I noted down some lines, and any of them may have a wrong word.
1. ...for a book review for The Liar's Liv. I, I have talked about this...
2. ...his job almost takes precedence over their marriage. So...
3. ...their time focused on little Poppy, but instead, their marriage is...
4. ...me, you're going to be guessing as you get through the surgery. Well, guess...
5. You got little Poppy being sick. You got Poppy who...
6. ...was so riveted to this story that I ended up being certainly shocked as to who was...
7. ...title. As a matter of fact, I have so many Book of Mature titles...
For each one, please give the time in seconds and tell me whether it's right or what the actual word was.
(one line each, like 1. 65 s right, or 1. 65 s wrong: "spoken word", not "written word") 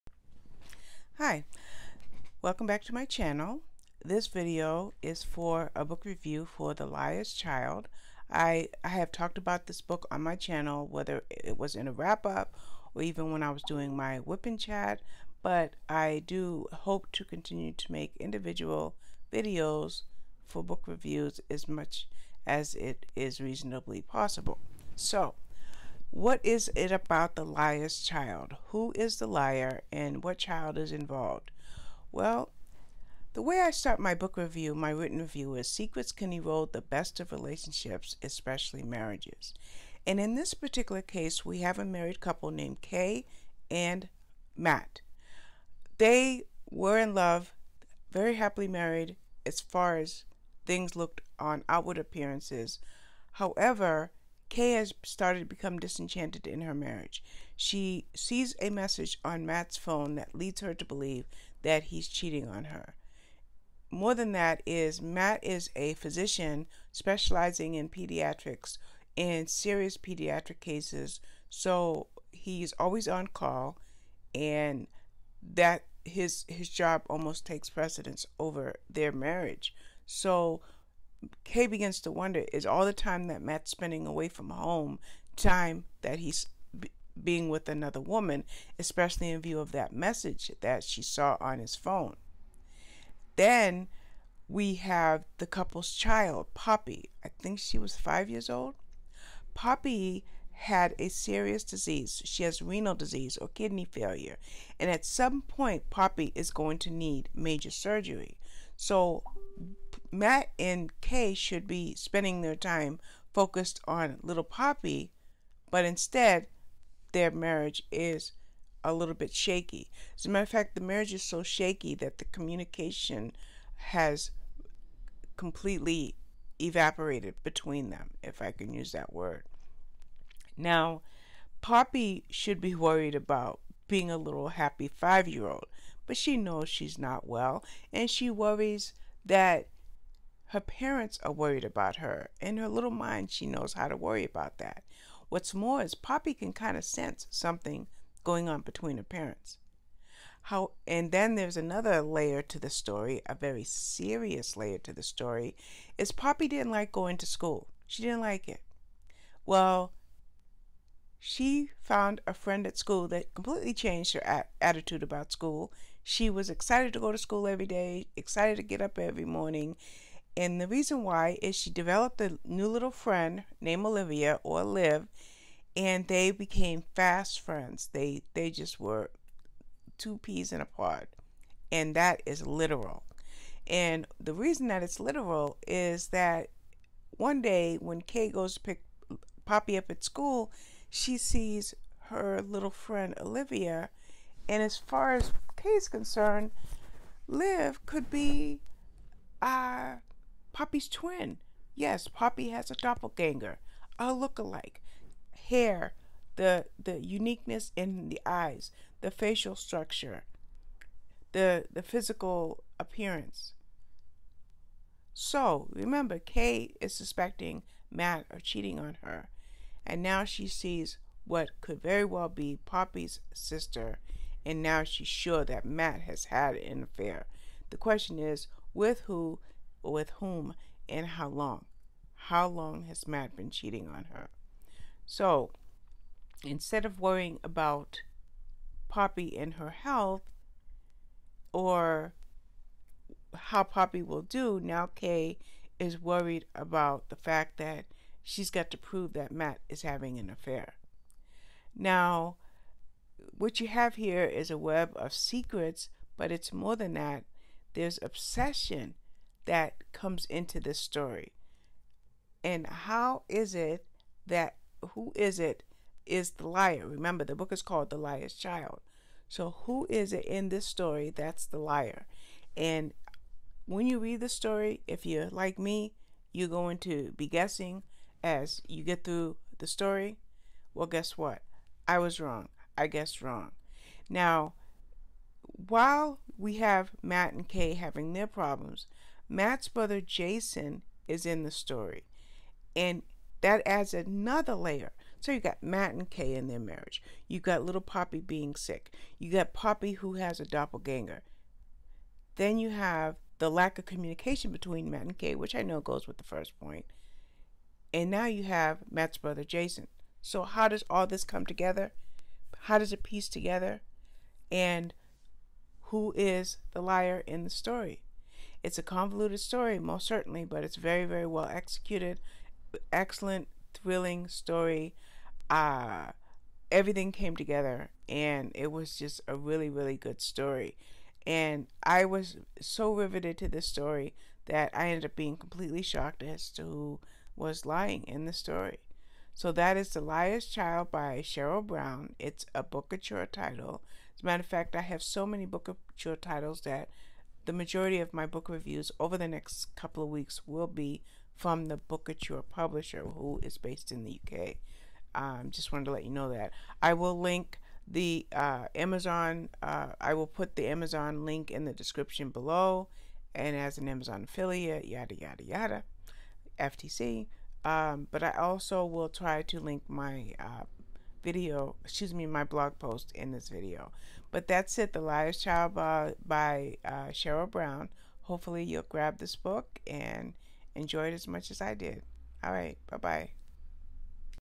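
1. 5 s wrong: "Child", not "Liv"
2. 76 s right
3. 112 s right
4. 275 s wrong: "story", not "surgery"
5. 297 s right
6. 332 s wrong: "completely", not "certainly"
7. 343 s right.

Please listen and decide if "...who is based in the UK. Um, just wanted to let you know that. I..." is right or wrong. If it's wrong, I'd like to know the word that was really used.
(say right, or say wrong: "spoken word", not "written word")
right.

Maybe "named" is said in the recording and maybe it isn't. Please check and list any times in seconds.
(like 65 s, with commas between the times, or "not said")
42 s, 173 s.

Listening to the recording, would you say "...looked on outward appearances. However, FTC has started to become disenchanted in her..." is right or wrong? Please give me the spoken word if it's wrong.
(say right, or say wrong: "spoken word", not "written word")
wrong: "Kay", not "FTC".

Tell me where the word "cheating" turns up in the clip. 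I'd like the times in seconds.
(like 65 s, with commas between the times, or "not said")
62 s, 218 s, 233 s.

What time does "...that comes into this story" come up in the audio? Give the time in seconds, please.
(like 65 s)
259 s.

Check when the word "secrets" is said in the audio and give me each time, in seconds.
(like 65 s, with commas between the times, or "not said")
35 s, 255 s.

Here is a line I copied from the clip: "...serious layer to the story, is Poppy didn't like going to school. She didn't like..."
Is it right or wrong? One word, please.
right.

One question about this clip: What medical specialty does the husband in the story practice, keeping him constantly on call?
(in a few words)
pediatrics.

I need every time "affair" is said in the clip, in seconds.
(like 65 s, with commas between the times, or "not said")
226 s, 250 s.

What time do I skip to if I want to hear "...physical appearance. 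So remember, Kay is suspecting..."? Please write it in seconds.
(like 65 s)
211 s.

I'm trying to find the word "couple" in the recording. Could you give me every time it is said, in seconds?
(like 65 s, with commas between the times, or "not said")
42 s, 95 s, 349 s.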